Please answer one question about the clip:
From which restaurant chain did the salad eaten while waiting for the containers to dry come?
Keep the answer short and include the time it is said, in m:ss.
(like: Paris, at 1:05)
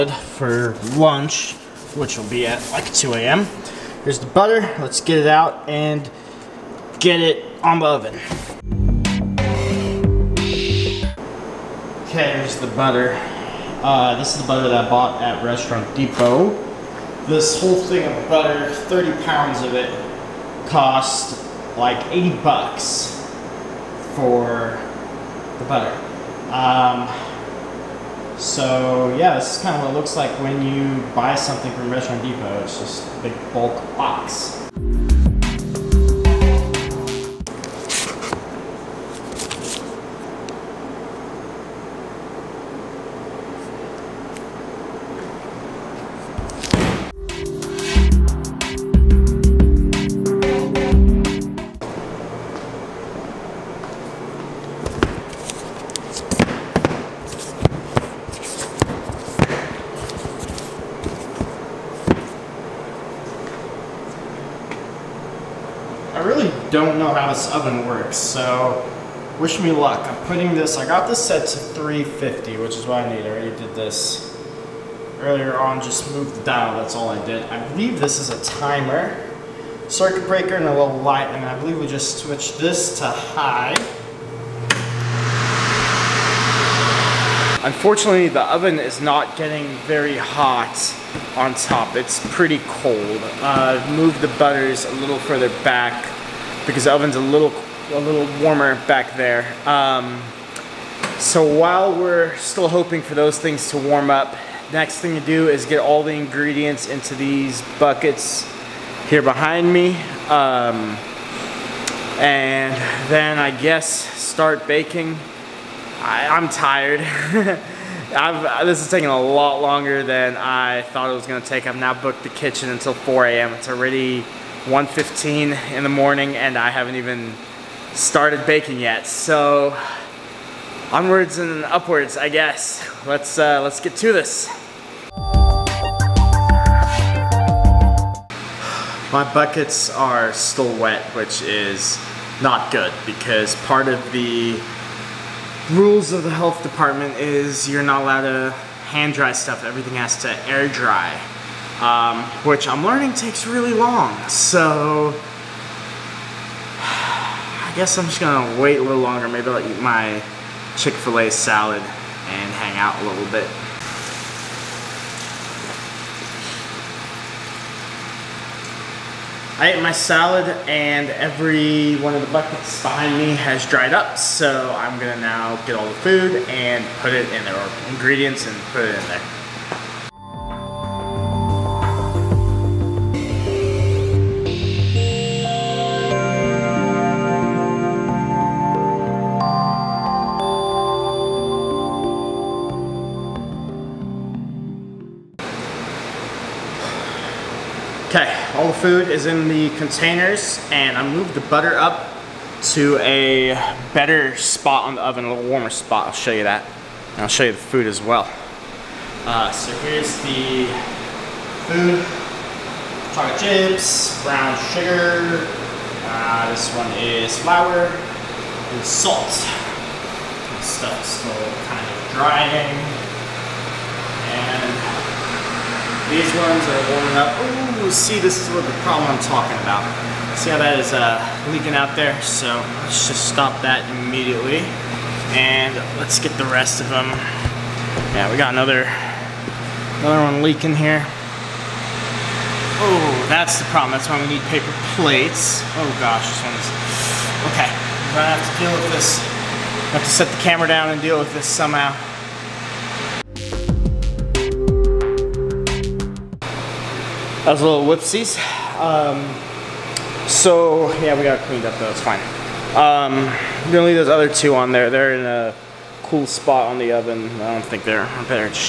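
Chick-fil-A, at 2:40.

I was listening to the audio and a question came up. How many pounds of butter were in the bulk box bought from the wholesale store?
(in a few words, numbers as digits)
30.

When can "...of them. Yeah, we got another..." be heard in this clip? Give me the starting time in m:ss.
3:56.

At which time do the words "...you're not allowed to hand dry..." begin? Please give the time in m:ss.
2:27.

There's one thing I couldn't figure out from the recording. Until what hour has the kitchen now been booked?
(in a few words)
4 a.m.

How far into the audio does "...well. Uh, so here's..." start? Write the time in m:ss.
3:27.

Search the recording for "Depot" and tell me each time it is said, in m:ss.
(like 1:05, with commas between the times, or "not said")
0:15, 0:32.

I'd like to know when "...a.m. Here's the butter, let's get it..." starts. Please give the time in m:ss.
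0:03.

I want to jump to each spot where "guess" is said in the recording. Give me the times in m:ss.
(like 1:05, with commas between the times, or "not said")
1:53, 2:12, 2:37.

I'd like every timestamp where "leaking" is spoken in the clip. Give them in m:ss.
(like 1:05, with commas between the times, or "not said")
3:51, 4:00.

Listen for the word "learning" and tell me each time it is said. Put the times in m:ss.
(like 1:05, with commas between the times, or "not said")
2:32.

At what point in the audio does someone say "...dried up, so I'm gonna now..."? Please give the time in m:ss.
2:53.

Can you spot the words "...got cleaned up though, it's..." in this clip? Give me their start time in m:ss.
4:21.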